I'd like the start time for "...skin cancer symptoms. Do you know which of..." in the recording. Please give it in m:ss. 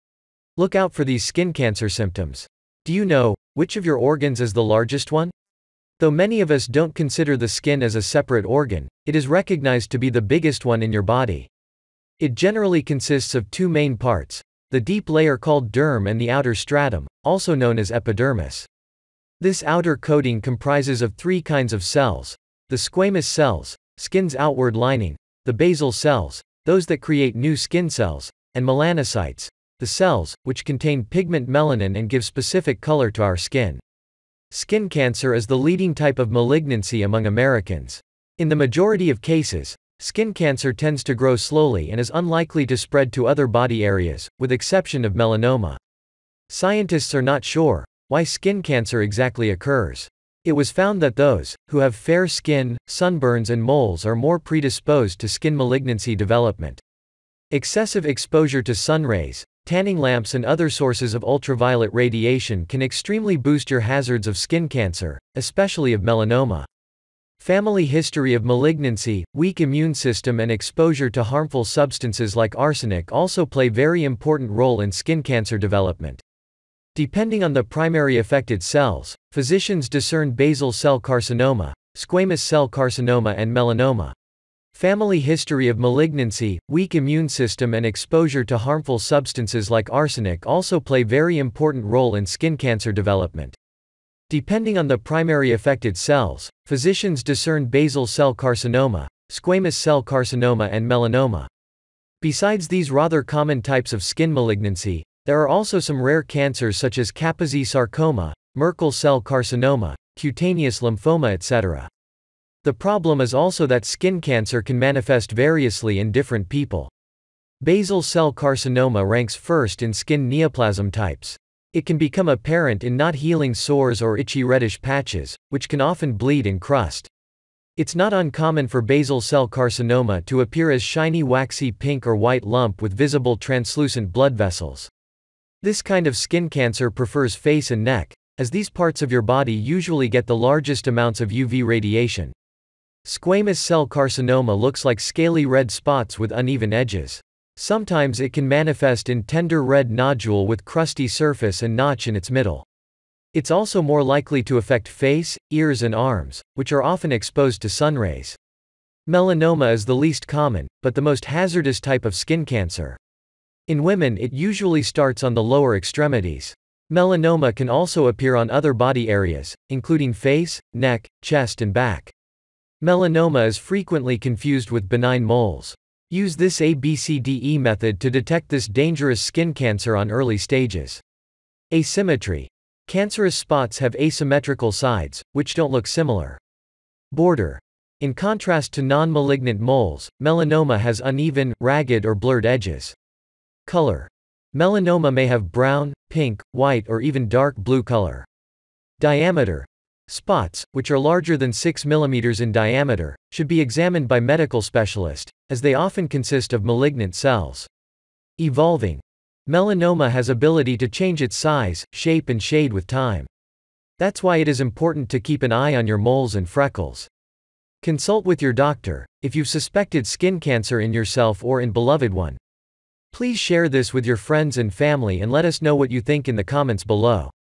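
0:01.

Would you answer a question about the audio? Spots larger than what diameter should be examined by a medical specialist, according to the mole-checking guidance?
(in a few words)
6 mm.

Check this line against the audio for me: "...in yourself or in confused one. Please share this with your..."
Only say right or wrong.
wrong.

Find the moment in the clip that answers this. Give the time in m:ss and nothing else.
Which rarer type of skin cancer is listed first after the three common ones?
1:47.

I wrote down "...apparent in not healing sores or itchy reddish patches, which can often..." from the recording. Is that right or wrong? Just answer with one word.
right.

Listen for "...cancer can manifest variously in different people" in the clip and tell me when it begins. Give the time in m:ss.
1:54.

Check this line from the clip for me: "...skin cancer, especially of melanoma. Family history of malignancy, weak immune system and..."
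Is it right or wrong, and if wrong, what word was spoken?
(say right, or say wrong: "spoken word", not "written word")
right.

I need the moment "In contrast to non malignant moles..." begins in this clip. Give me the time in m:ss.
3:07.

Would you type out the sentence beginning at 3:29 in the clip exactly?
Melanoma has ability to change its size, shape and shade with time.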